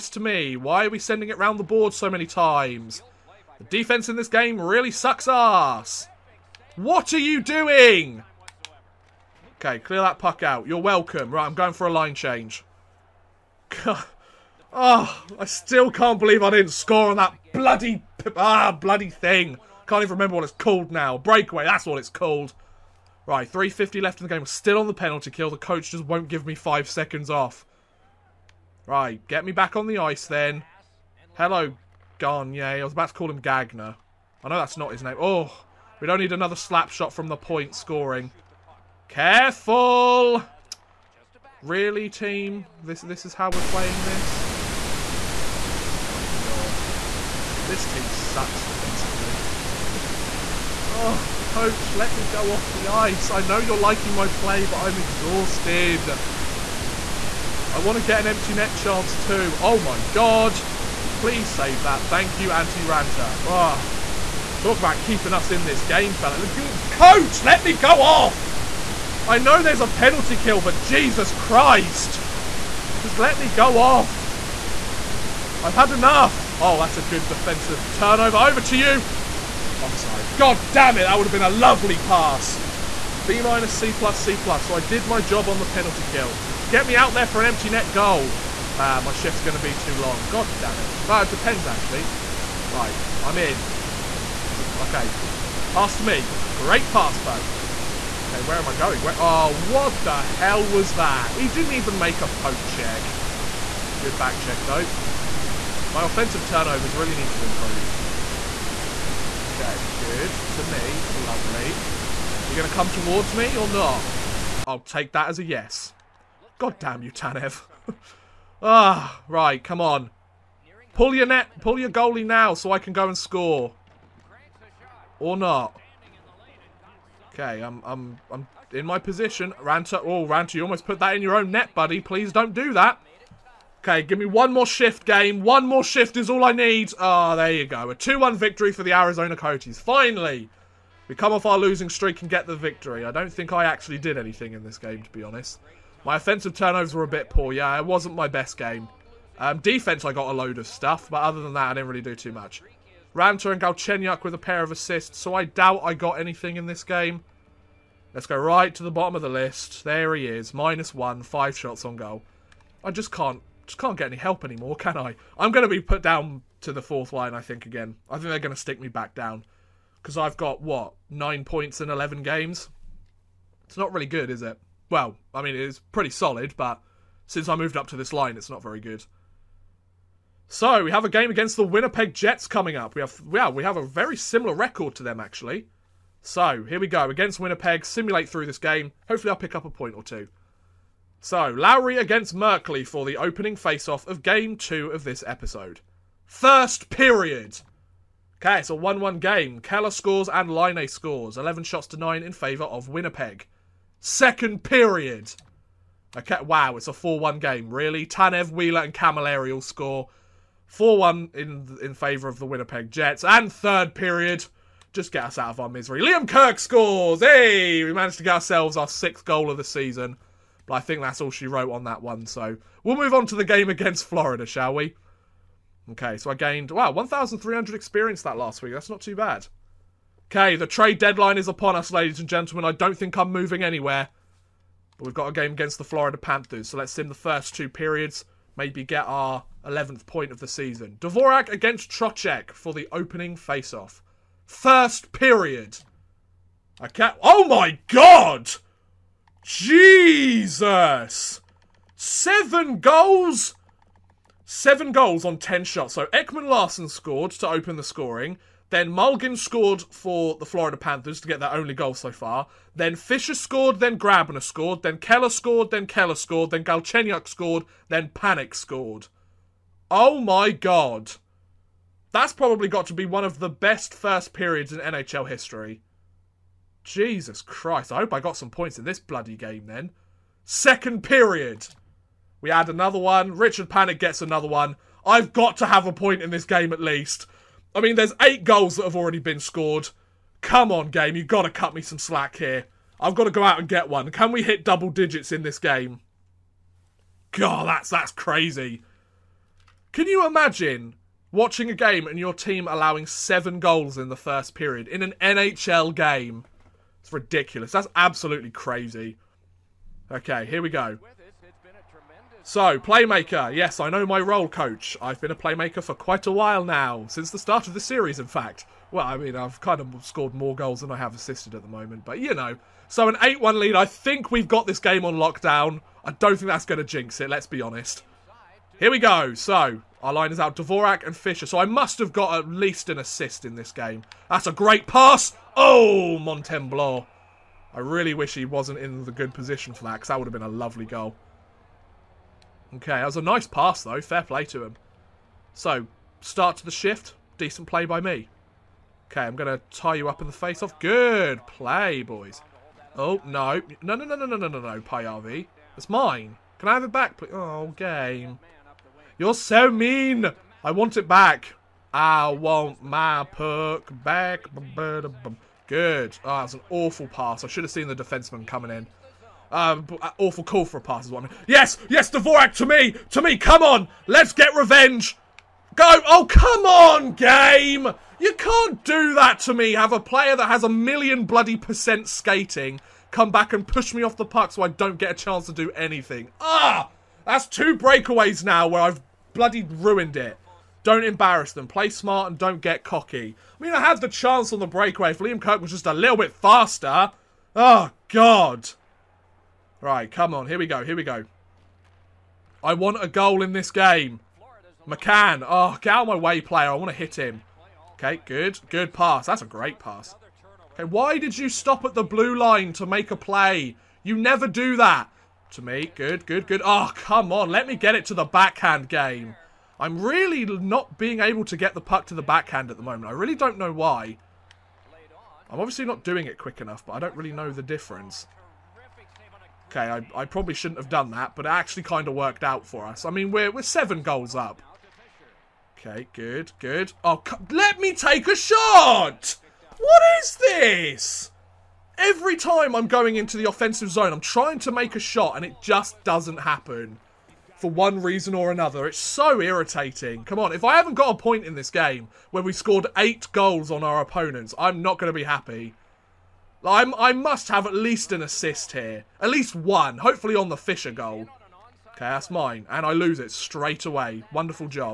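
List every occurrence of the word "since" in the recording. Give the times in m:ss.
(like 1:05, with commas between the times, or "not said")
2:57, 5:17.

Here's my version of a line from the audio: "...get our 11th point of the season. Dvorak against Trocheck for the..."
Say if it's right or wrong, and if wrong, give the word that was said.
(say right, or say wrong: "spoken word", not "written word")
right.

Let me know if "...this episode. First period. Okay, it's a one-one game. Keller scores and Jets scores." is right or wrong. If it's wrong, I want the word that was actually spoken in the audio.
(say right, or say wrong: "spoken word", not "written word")
wrong: "Laine", not "Jets".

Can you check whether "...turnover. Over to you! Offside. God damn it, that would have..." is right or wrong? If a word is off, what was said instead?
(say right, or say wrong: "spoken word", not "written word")
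right.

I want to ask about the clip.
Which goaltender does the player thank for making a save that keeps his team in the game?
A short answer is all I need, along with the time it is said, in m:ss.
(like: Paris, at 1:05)
Antti Raanta, at 1:02.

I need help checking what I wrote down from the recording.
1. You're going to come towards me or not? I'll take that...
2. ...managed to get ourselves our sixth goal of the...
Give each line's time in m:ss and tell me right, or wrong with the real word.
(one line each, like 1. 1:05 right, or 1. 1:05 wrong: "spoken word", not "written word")
1. 1:52 right
2. 3:37 right.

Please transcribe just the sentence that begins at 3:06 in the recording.
So here we go against Winnipeg.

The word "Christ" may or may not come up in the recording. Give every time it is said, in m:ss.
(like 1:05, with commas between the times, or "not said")
1:11, 4:37.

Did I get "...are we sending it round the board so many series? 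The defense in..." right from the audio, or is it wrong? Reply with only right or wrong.
wrong.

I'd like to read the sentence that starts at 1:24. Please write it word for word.
So I did my job on the penalty kill.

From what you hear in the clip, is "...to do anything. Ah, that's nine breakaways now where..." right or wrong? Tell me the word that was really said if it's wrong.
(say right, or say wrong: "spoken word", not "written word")
wrong: "two", not "nine".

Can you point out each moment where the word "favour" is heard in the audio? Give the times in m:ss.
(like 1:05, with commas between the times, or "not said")
3:22, 3:31.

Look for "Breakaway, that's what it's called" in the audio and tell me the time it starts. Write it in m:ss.
0:21.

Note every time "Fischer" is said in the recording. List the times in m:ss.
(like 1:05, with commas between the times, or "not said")
4:22, 5:31, 7:40.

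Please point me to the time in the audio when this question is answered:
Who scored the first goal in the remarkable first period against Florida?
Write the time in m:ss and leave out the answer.
4:16.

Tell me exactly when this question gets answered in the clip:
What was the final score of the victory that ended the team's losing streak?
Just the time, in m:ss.
2:17.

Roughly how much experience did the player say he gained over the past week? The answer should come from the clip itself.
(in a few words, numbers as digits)
1,300.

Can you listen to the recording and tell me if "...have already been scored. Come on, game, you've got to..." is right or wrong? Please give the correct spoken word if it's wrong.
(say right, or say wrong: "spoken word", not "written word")
right.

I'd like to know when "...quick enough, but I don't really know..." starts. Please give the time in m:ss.
7:06.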